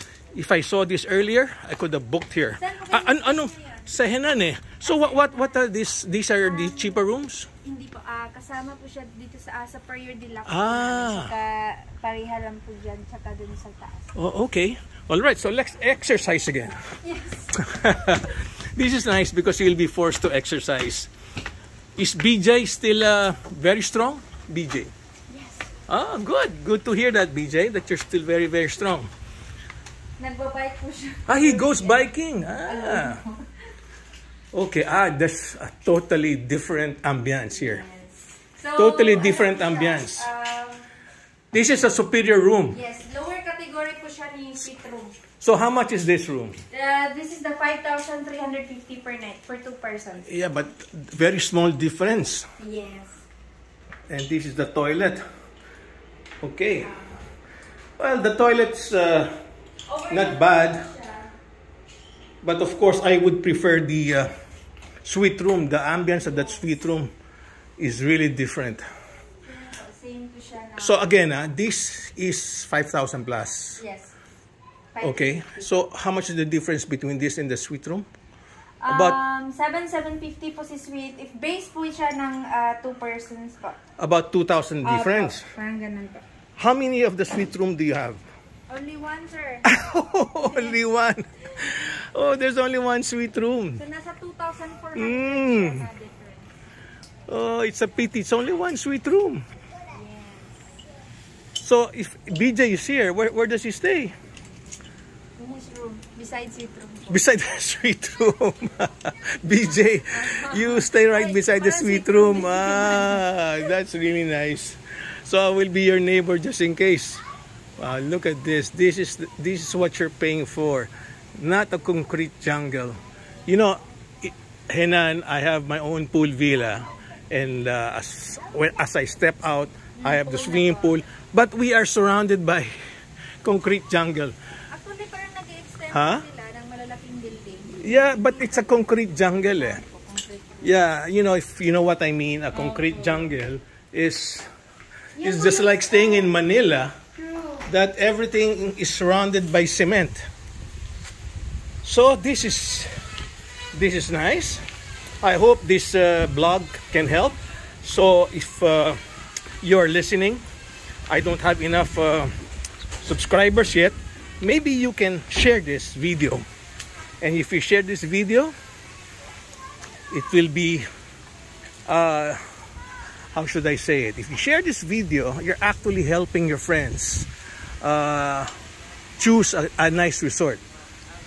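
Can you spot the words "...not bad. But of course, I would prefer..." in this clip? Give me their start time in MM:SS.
01:00.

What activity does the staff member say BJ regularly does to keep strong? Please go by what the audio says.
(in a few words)
Biking.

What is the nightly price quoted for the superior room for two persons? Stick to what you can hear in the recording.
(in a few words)
5,350.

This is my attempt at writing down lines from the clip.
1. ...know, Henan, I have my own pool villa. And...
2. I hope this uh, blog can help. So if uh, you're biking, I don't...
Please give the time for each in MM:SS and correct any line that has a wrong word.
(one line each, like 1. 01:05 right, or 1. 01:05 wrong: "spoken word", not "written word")
1. 02:03 right
2. 02:35 wrong: "listening", not "biking".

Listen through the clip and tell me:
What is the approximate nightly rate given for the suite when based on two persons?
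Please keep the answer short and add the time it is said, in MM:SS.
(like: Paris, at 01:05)
7,750, at 01:19.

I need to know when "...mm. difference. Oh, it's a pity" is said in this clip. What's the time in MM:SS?
01:34.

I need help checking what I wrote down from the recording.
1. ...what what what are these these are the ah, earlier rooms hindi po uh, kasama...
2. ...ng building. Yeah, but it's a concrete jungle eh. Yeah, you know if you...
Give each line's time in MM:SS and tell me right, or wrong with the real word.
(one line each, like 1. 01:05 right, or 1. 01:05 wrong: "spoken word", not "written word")
1. 00:04 wrong: "cheaper", not "earlier"
2. 02:16 right.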